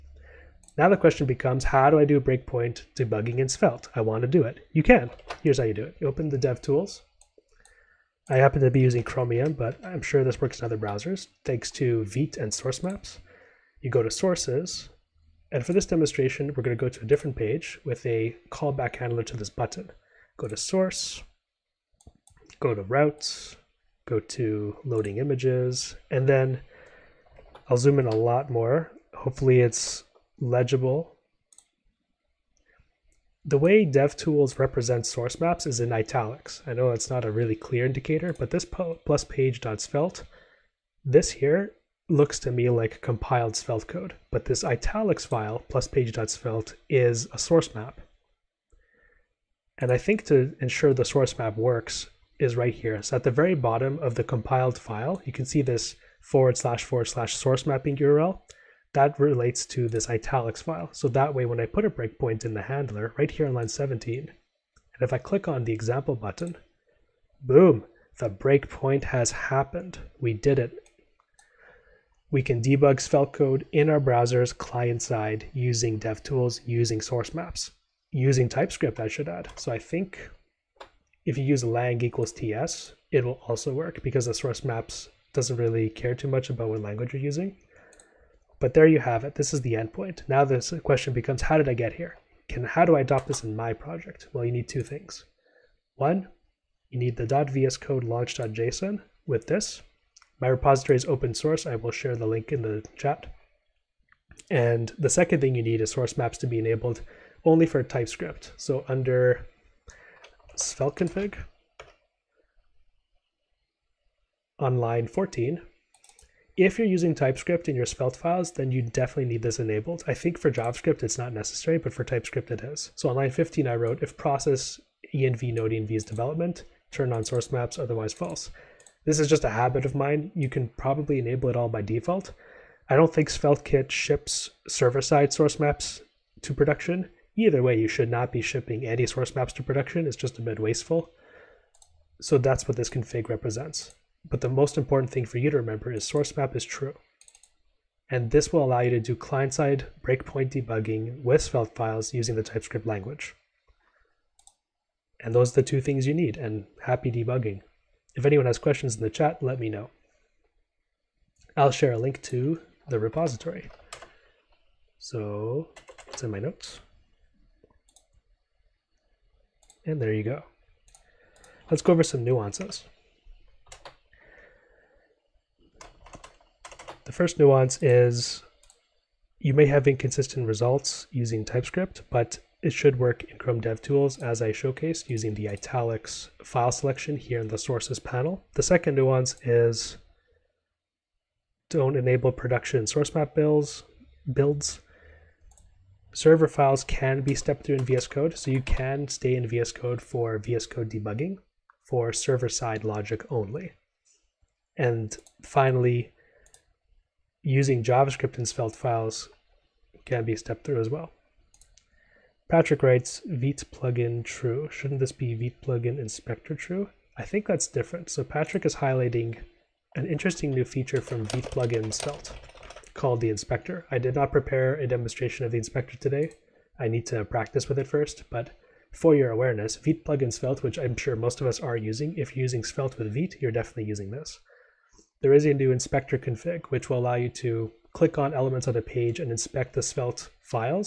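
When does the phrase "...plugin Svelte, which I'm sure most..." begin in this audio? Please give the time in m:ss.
3:50.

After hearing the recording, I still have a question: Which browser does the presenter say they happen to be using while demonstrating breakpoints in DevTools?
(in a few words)
Chromium.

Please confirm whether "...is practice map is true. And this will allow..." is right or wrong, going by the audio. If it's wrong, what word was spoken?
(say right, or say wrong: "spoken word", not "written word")
wrong: "source", not "practice".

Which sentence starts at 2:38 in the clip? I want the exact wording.
If anyone has questions in the chat, let me know.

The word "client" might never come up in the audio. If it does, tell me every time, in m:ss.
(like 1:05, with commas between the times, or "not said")
1:14, 2:29.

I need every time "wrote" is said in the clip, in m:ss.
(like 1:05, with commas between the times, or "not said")
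2:03.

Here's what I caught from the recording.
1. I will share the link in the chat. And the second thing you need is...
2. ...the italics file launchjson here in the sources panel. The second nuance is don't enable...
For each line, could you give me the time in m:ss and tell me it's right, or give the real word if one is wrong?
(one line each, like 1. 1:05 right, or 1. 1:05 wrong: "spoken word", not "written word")
1. 1:41 right
2. 3:05 wrong: "selection", not "launchjson".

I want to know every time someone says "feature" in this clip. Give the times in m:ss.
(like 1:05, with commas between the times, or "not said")
3:40.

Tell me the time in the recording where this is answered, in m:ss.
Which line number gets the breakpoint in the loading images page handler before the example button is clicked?
1:03.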